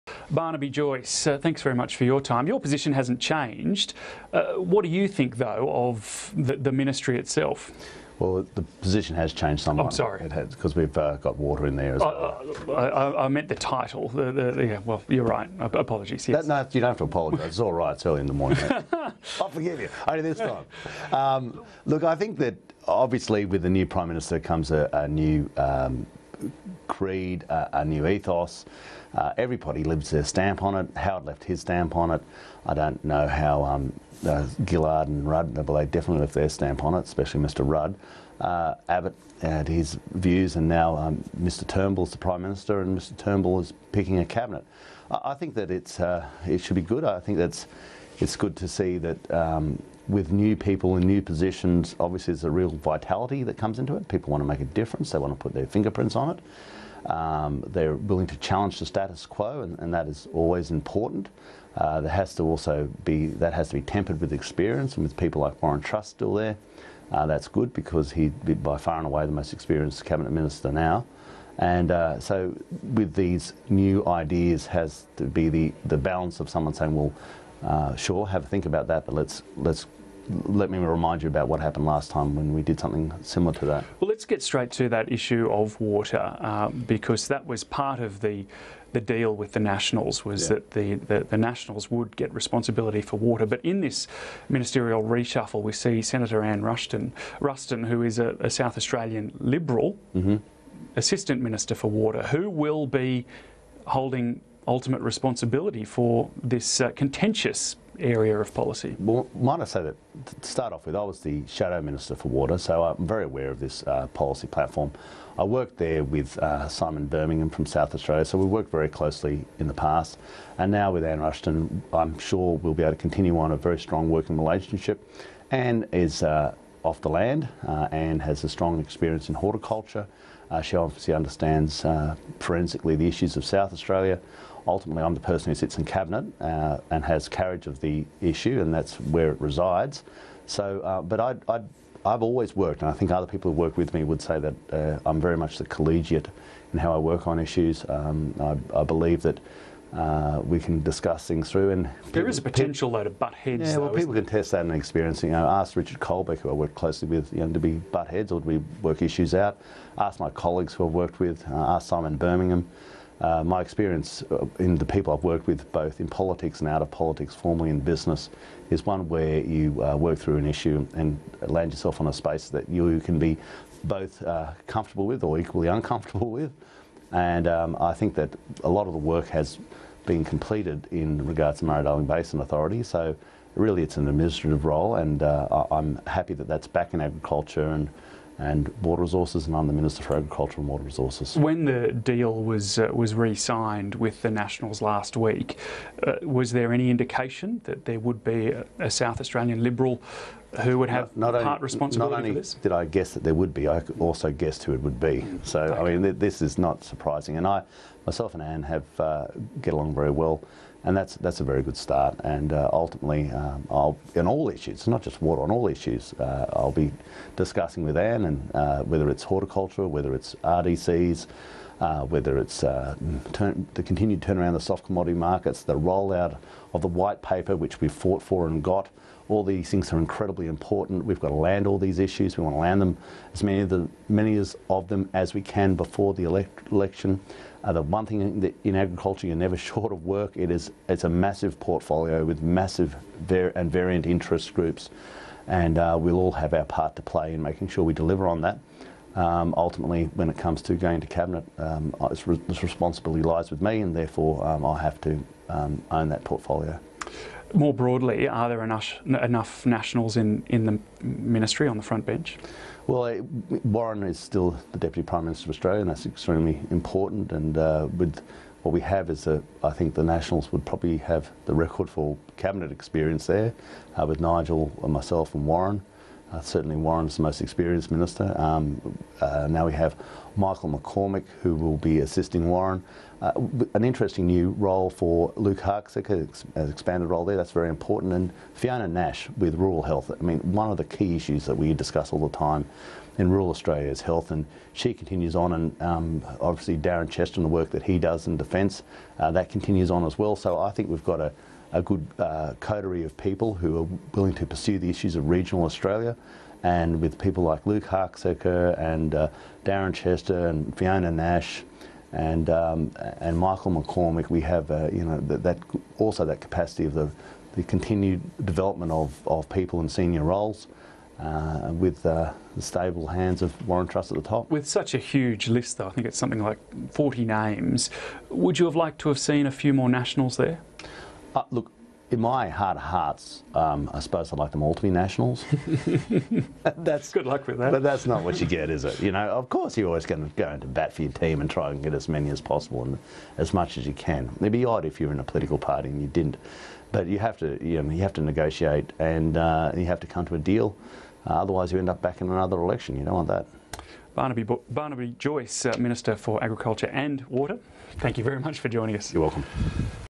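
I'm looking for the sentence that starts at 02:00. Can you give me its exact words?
And now with Anne Rushton, I'm sure we'll be able to continue on a very strong working relationship.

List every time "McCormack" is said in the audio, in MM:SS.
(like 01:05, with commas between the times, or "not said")
04:40, 05:13.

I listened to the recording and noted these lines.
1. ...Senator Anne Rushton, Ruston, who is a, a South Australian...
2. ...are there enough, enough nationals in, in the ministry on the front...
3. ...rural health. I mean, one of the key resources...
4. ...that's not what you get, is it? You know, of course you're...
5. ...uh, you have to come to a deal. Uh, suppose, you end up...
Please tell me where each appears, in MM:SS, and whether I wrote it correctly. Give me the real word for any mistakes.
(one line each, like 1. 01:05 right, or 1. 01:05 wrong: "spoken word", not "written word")
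1. 01:36 right
2. 04:18 right
3. 04:49 wrong: "issues", not "resources"
4. 05:37 right
5. 05:49 wrong: "otherwise", not "suppose".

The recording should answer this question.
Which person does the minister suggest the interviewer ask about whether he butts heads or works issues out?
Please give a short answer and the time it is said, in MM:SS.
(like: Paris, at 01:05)
Richard Colbeck, at 02:35.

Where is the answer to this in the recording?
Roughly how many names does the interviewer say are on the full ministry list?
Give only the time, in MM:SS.
05:26.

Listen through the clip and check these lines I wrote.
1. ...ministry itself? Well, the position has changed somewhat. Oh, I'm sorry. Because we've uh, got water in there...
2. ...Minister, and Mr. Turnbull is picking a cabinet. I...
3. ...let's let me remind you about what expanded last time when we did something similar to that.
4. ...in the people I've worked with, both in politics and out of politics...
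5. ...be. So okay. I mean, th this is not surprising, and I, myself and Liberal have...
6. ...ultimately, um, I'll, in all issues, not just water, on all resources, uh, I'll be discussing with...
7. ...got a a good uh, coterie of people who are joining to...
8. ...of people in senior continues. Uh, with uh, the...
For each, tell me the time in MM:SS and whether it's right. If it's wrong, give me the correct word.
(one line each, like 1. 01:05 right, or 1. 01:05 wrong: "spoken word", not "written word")
1. 00:06 right
2. 00:42 right
3. 01:19 wrong: "happened", not "expanded"
4. 02:44 right
5. 03:24 wrong: "Anne", not "Liberal"
6. 03:32 wrong: "issues", not "resources"
7. 05:01 wrong: "willing", not "joining"
8. 05:19 wrong: "roles", not "continues".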